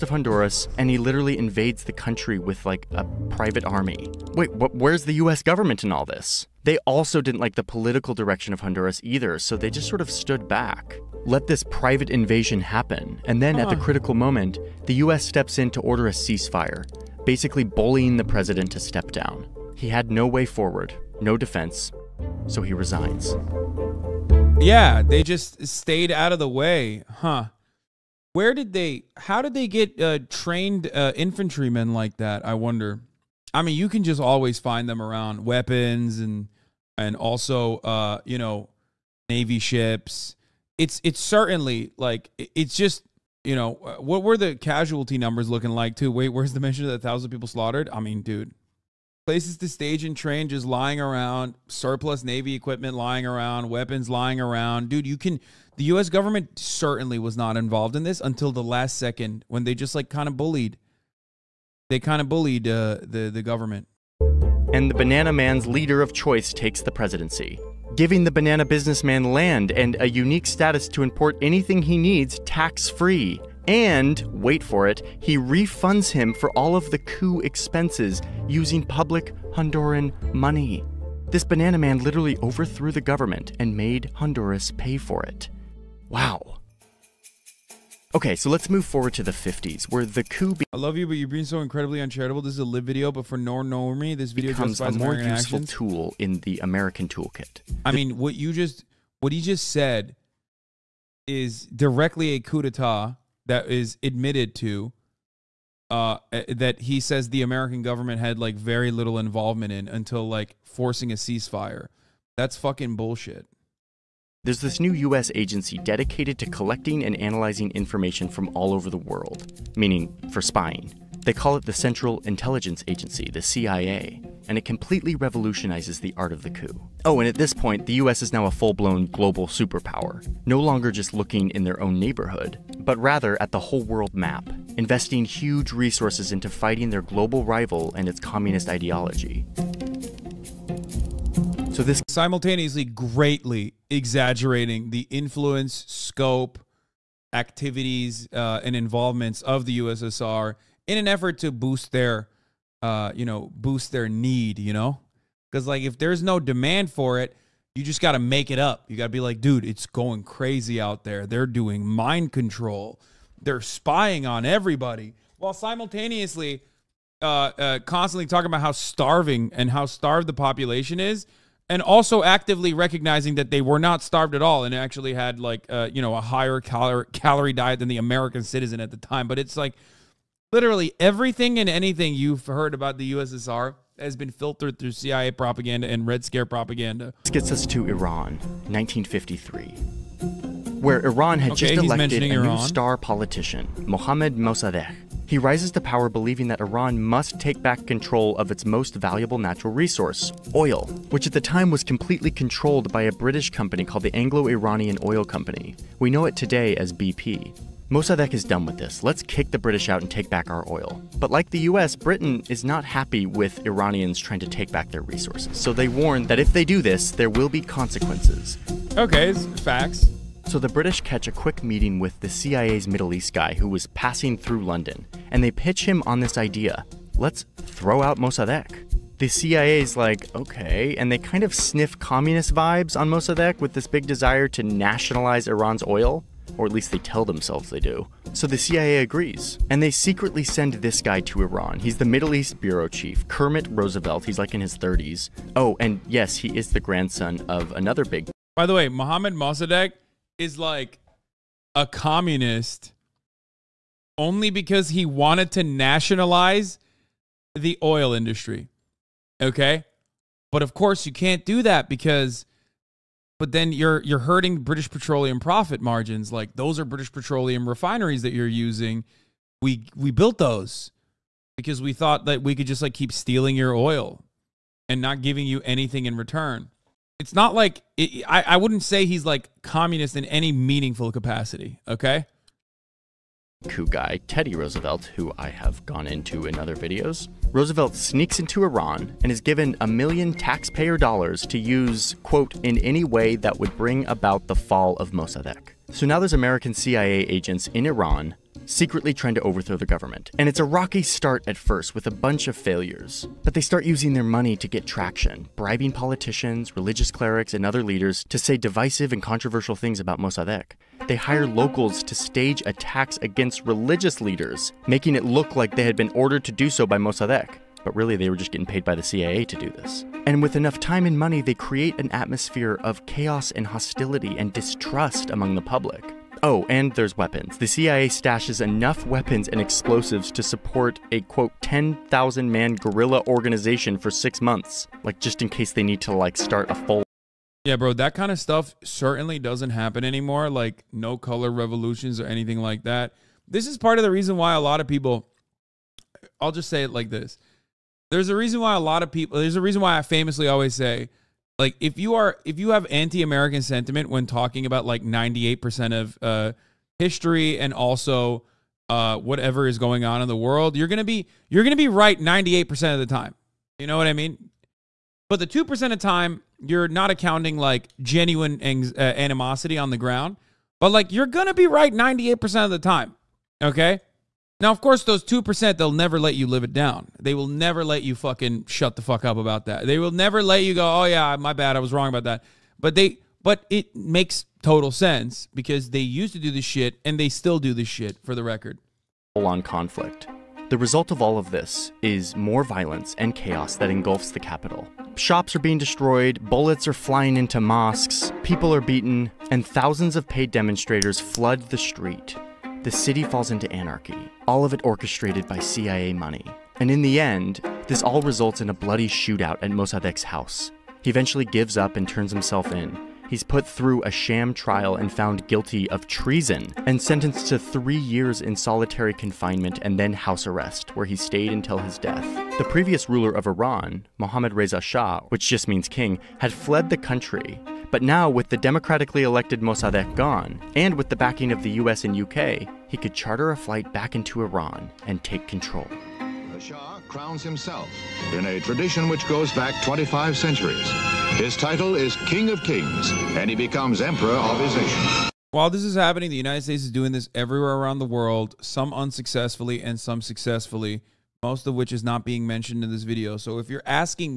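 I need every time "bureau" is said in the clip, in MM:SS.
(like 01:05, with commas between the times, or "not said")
04:02.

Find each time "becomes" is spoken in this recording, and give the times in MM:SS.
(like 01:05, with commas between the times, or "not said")
01:34, 07:23.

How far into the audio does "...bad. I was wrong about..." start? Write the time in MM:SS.
06:21.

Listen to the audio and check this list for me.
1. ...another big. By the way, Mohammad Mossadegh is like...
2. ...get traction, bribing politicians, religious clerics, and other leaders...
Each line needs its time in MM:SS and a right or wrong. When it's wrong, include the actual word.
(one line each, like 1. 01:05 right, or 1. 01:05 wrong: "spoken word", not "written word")
1. 04:07 right
2. 05:04 right.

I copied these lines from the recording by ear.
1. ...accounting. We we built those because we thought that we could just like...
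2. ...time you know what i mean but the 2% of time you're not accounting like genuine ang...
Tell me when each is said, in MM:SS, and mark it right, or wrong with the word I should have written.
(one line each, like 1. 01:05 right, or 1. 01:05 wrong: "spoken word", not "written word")
1. 04:28 wrong: "using", not "accounting"
2. 06:03 right.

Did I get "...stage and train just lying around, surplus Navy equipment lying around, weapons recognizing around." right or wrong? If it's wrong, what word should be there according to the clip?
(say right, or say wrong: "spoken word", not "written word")
wrong: "lying", not "recognizing".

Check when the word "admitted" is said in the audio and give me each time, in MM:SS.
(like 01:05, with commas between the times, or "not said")
01:44.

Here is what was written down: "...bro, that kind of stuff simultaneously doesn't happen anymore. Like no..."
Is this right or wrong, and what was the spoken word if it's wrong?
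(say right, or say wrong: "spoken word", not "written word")
wrong: "certainly", not "simultaneously".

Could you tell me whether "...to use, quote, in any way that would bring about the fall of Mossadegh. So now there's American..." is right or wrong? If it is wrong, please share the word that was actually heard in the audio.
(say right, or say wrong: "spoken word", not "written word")
right.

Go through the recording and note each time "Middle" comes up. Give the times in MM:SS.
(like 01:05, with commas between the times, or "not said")
03:42, 04:02.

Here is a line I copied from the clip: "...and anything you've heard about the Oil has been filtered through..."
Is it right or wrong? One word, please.
wrong.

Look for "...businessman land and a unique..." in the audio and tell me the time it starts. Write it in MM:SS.
01:08.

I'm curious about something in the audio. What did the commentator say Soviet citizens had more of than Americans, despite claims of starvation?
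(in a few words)
calorie diet.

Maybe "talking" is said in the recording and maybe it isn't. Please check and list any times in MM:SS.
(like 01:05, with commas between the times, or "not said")
02:48, 05:54.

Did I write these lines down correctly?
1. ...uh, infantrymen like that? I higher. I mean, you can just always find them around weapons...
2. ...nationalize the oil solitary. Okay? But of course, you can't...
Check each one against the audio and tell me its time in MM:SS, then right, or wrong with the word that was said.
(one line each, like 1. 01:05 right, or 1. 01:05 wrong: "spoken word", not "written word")
1. 00:30 wrong: "wonder", not "higher"
2. 04:15 wrong: "industry", not "solitary".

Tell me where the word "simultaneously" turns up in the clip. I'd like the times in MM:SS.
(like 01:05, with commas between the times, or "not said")
02:22, 02:45.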